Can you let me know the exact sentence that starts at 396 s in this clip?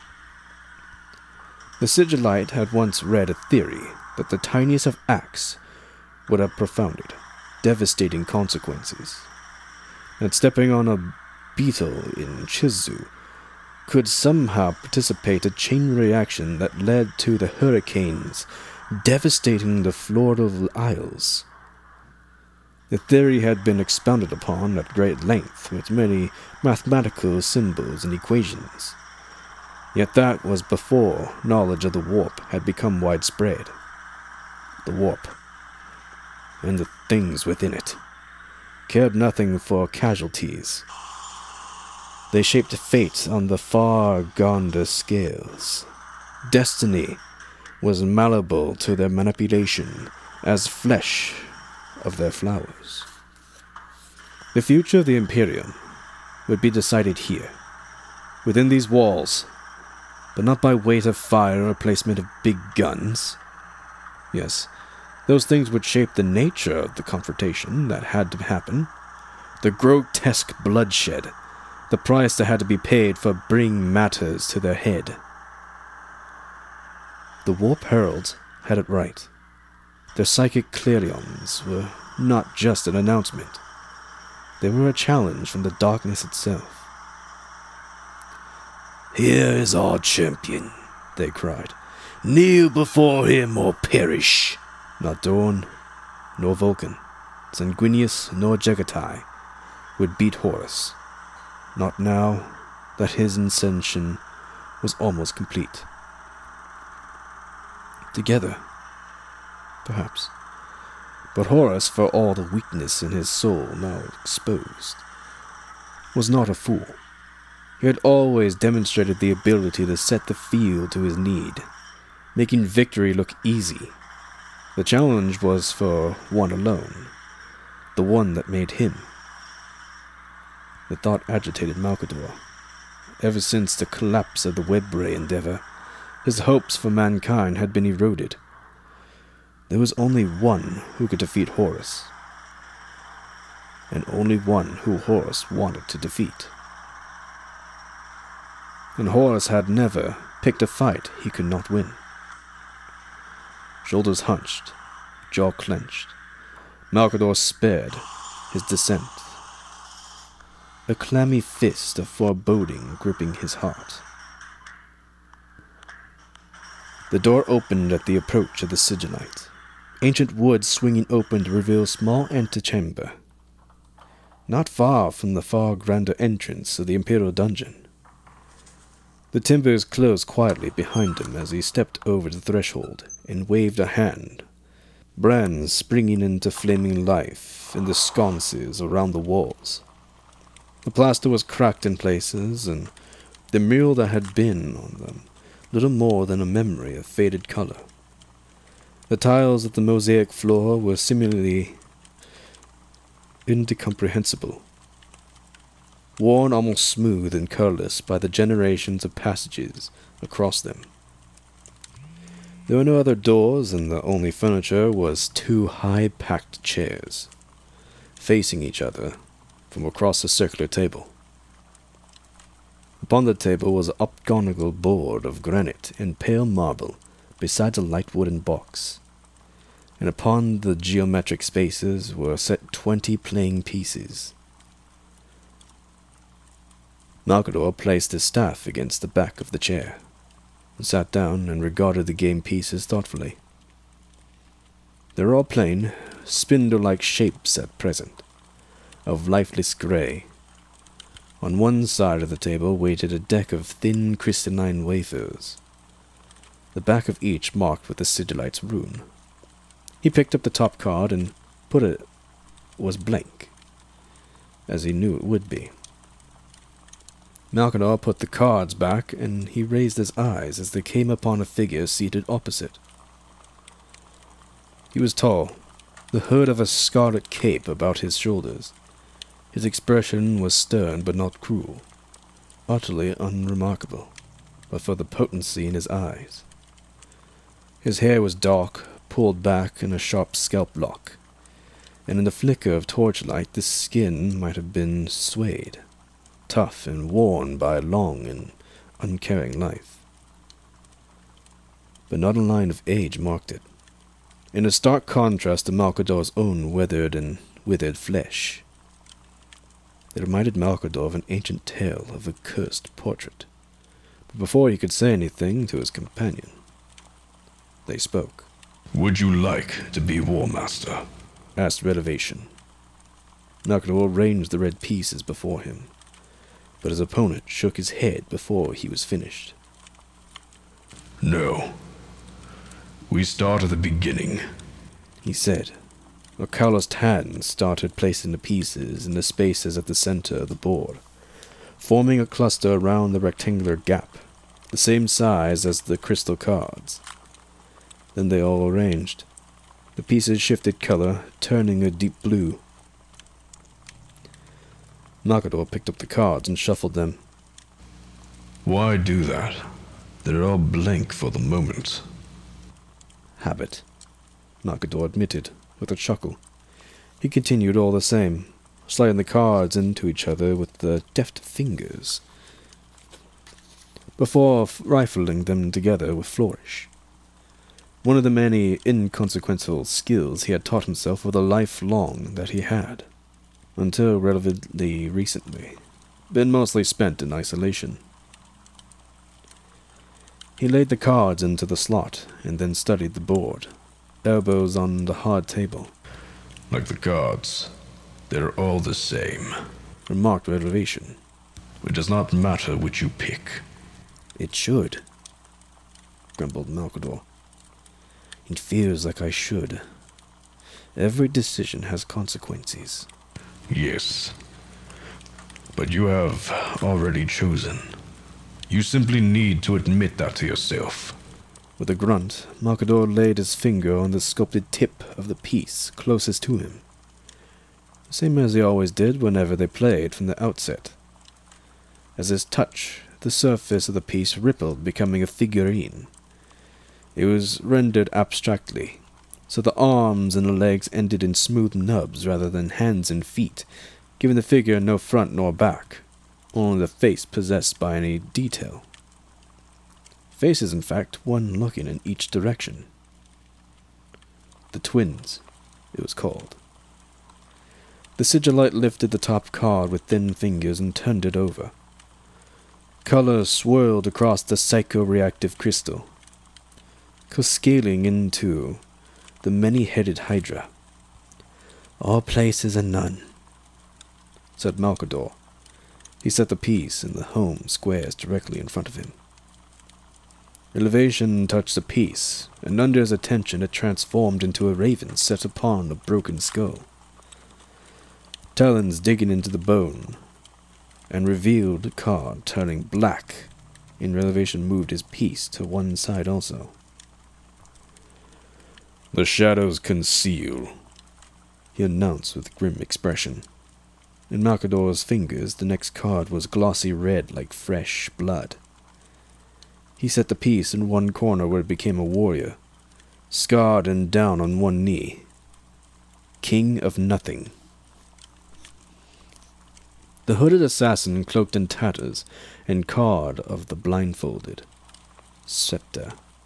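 Like the gods, they're all the same.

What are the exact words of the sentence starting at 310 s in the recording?
It reminded Malcador of an ancient tale of a cursed portrait.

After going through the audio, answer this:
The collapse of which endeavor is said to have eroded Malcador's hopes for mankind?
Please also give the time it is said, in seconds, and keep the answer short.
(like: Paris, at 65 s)
Webway, at 134 s.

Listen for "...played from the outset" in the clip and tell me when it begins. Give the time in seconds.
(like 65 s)
429 s.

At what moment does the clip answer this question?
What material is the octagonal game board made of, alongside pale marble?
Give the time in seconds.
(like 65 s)
225 s.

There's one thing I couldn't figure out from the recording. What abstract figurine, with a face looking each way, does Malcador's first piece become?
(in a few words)
The twins.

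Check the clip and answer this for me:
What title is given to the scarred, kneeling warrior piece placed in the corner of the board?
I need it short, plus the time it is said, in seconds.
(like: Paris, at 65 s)
King of nothing, at 516 s.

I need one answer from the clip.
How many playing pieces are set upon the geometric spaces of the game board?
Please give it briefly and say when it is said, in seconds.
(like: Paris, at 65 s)
20, at 232 s.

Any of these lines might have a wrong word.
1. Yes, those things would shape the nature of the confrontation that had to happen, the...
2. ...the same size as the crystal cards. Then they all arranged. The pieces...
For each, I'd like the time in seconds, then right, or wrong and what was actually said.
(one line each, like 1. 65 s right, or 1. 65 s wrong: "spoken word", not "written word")
1. 64 s right
2. 344 s right.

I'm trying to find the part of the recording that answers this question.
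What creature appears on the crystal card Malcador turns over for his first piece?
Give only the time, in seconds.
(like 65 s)
469 s.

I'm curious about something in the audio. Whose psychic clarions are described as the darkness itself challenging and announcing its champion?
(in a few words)
The Warp Herald.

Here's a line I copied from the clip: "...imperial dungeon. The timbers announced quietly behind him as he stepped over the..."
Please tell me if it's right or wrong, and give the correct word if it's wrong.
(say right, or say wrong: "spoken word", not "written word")
wrong: "closed", not "announced".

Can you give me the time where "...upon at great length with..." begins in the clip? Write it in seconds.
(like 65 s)
24 s.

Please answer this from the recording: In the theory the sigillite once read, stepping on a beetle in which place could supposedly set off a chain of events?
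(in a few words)
Chizu.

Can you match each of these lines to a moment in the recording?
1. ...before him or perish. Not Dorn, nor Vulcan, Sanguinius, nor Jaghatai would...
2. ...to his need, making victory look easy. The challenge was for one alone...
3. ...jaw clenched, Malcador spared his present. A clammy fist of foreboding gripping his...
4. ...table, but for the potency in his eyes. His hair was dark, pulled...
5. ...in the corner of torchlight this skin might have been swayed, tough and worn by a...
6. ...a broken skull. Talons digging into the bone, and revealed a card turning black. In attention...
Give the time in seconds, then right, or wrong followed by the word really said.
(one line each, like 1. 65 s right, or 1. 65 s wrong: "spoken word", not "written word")
1. 92 s right
2. 120 s right
3. 155 s wrong: "descent", not "present"
4. 283 s wrong: "unremarkable", not "table"
5. 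292 s wrong: "flicker", not "corner"
6. 485 s wrong: "elevation", not "attention".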